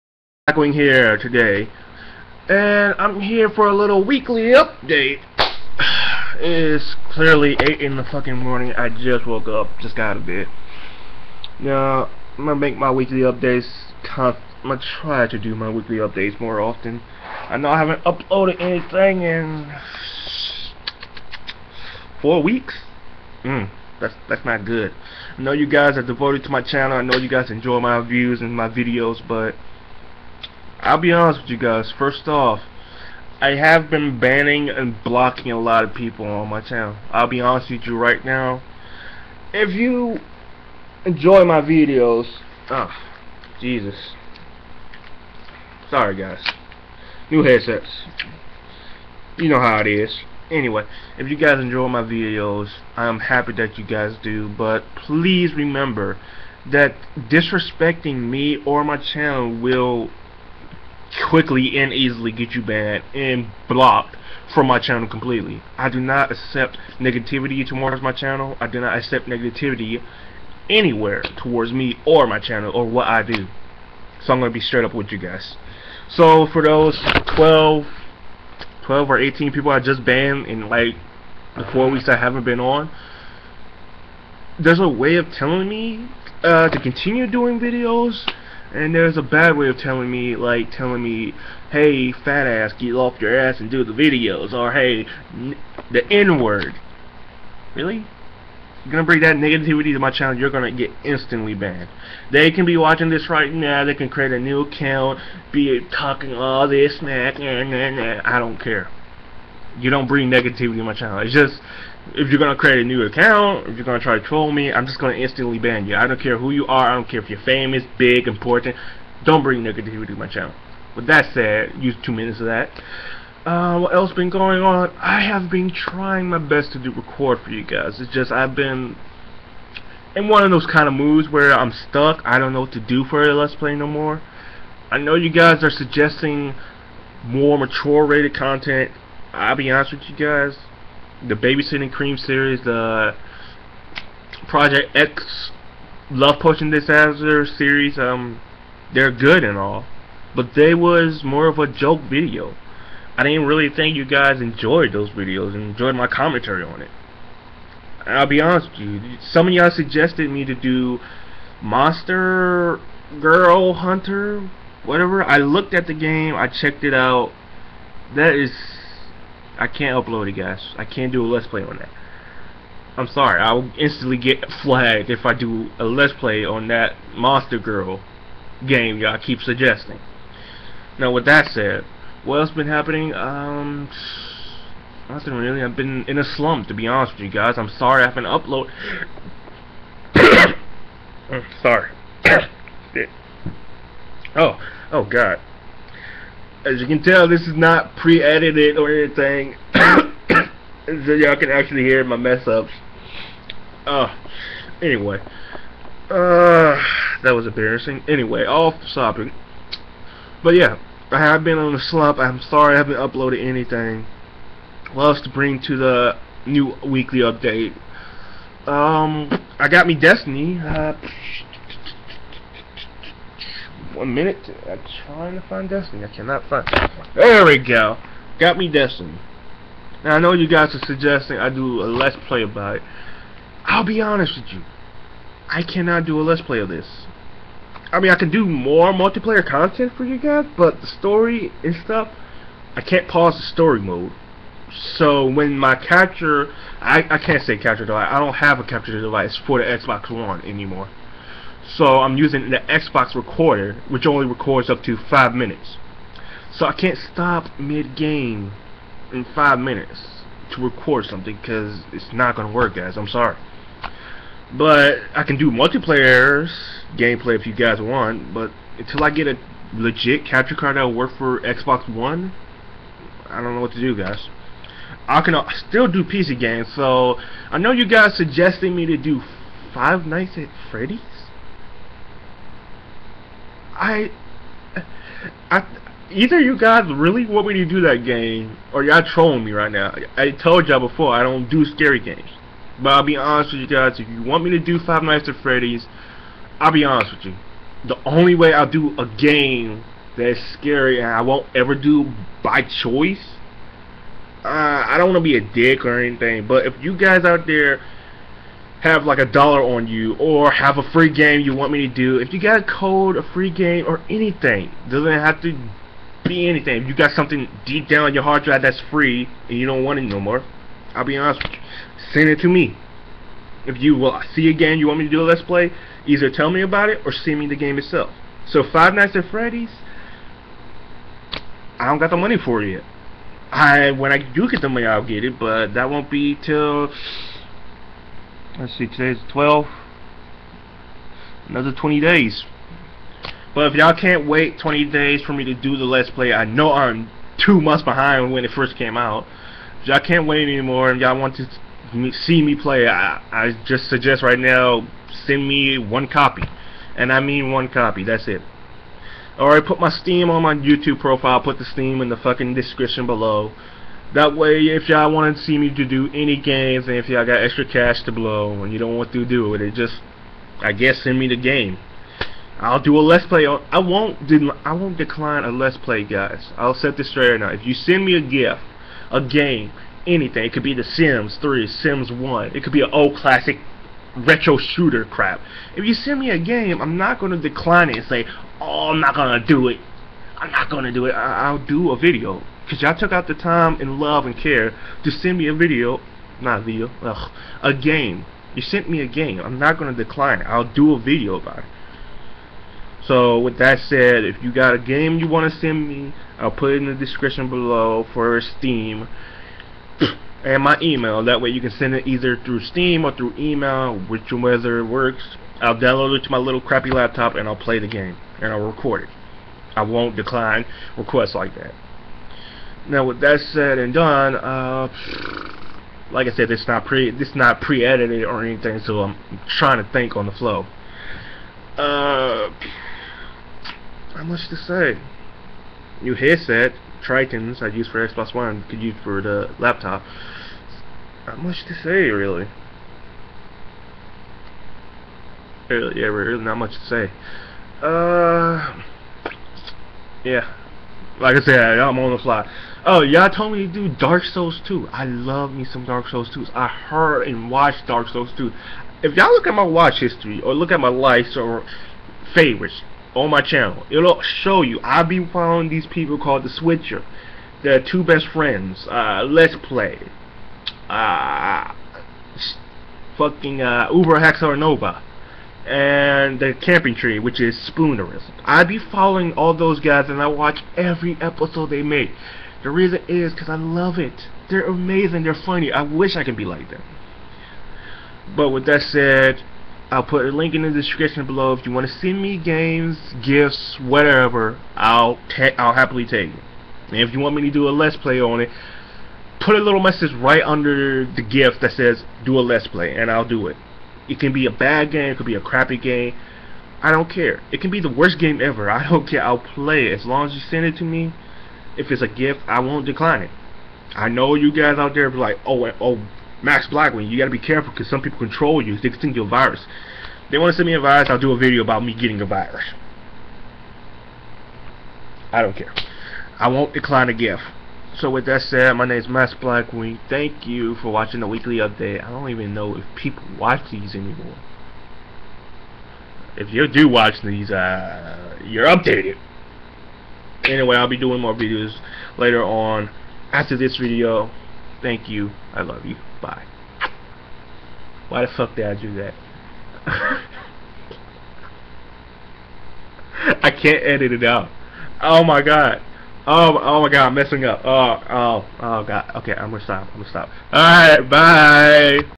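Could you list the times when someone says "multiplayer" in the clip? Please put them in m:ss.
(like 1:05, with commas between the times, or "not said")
3:58, 4:25.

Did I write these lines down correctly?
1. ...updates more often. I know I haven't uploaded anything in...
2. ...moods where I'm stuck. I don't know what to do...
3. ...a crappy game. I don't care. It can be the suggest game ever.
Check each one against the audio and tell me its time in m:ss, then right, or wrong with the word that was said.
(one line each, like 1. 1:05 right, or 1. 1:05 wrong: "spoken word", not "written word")
1. 0:15 right
2. 2:10 right
3. 8:25 wrong: "worst", not "suggest".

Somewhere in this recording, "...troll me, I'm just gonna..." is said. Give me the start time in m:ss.
1:54.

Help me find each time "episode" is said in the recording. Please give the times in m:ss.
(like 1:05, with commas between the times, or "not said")
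8:01.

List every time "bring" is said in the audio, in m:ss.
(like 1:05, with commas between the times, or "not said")
1:39, 1:50, 1:59, 3:35.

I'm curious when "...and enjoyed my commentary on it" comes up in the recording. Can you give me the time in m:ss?
2:35.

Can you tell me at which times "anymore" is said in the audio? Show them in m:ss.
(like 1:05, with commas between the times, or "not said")
4:10, 5:50, 8:53.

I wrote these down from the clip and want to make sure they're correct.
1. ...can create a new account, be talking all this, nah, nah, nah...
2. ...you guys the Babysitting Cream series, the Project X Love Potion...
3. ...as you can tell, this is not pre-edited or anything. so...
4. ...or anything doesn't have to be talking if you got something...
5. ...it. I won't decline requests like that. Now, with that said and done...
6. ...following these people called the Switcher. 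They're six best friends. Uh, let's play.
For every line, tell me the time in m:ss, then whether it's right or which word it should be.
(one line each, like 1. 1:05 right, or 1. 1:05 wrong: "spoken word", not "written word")
1. 1:43 right
2. 2:20 right
3. 3:16 right
4. 5:13 wrong: "anything", not "talking"
5. 6:59 right
6. 7:45 wrong: "two", not "six".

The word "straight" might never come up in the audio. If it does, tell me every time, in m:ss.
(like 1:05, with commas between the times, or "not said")
1:14, 6:17.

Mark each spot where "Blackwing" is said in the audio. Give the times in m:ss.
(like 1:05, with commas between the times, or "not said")
8:36, 8:49.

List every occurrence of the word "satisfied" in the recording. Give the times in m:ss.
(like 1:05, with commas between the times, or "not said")
not said.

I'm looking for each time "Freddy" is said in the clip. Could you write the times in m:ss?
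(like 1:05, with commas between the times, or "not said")
4:40, 4:55, 5:29.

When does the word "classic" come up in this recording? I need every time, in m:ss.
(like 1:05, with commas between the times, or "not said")
6:23.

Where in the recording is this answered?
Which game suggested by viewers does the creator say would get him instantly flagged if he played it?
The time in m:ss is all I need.
2:41.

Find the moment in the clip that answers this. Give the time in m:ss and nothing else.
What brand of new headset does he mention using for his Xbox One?
7:17.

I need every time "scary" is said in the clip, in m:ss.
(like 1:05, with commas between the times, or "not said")
4:51, 5:00.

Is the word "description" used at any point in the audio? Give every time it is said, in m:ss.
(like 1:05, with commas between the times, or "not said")
6:02, 6:46, 8:10.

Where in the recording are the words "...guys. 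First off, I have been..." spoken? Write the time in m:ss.
0:31.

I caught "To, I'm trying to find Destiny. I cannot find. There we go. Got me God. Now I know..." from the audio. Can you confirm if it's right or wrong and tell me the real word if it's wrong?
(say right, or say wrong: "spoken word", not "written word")
wrong: "Destiny", not "God".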